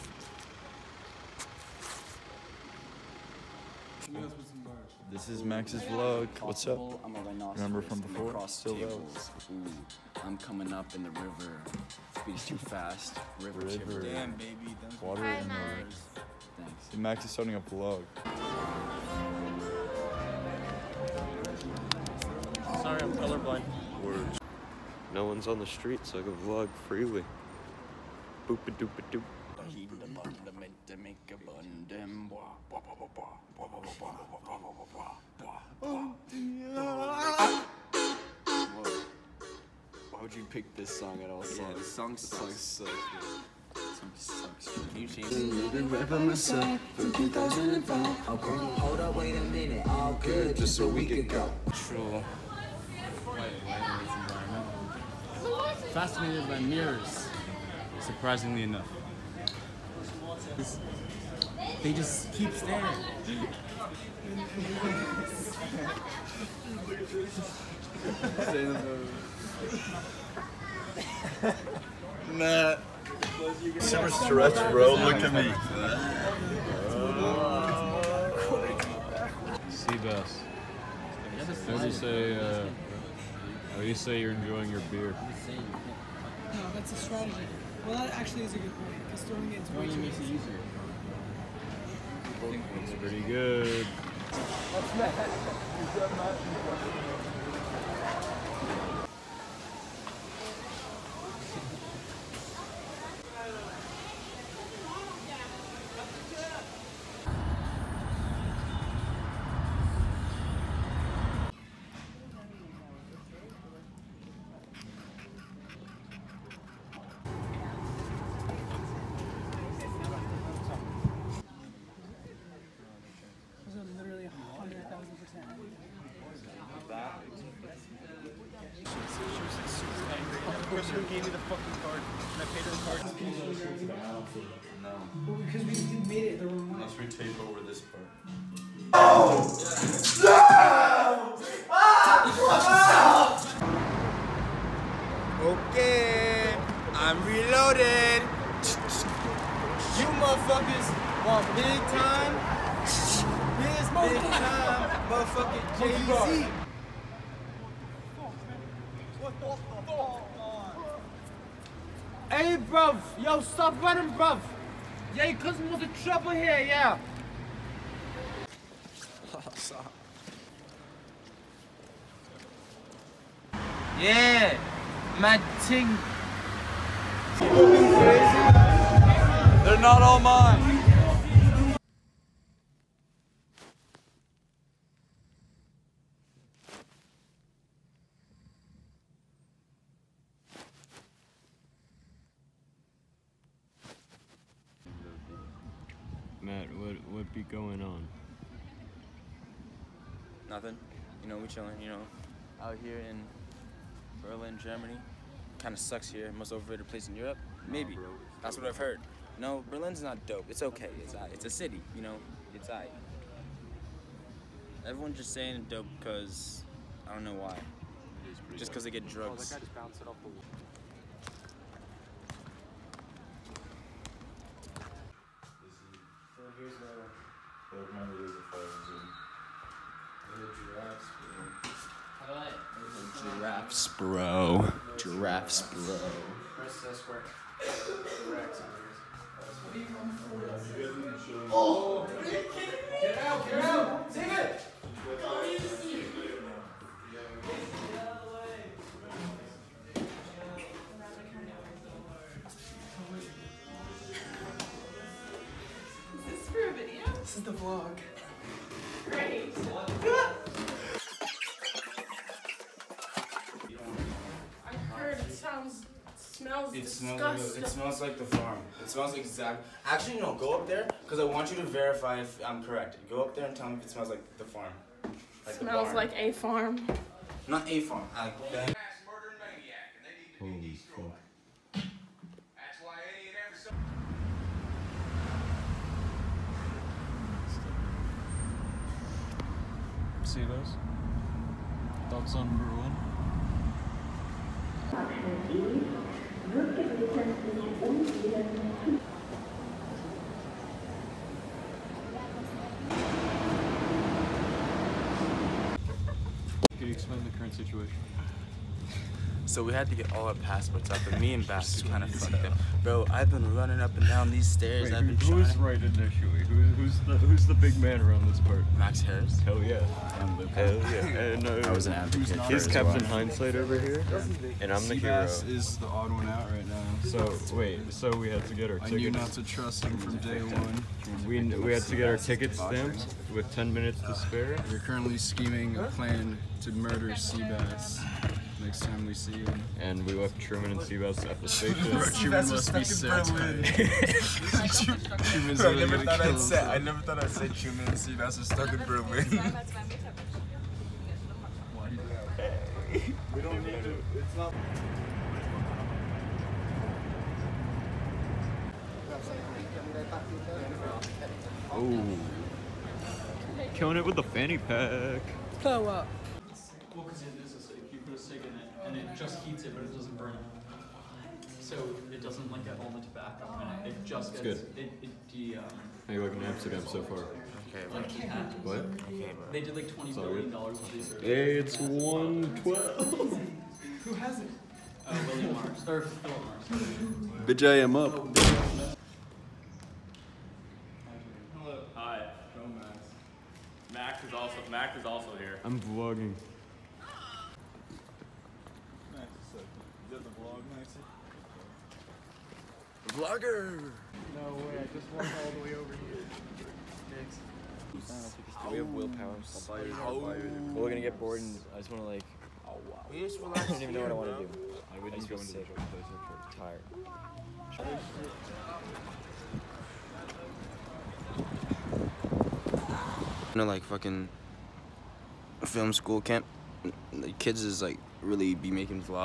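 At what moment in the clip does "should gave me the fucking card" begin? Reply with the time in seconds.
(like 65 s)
130 s.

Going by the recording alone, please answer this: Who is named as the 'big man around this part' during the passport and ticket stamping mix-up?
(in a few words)
Max Harris.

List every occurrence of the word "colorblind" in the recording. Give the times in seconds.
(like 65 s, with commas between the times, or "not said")
23 s.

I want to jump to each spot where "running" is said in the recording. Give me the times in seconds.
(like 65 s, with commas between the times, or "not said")
163 s, 313 s.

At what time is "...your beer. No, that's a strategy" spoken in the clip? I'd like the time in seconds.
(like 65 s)
84 s.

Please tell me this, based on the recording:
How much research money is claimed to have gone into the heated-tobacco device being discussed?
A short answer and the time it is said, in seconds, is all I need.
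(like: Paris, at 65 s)
$20 billion, at 379 s.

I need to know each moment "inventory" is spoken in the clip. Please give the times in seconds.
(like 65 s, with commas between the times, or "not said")
not said.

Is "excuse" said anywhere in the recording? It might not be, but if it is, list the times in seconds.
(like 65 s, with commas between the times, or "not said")
not said.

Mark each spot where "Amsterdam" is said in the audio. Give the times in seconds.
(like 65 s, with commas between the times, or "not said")
376 s.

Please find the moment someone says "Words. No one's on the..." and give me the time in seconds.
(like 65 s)
24 s.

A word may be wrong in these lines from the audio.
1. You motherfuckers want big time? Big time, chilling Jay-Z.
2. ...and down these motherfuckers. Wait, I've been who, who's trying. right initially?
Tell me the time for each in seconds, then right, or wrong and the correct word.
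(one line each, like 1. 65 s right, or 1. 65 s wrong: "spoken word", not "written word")
1. 149 s wrong: "motherfucking", not "chilling"
2. 313 s wrong: "stairs", not "motherfuckers".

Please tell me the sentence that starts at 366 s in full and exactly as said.
Well, because it is a acidic.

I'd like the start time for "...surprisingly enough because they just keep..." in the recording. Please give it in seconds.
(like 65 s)
58 s.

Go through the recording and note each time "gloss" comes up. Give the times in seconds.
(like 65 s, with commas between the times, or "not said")
not said.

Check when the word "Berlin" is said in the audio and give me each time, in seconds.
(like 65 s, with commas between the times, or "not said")
204 s, 209 s, 348 s.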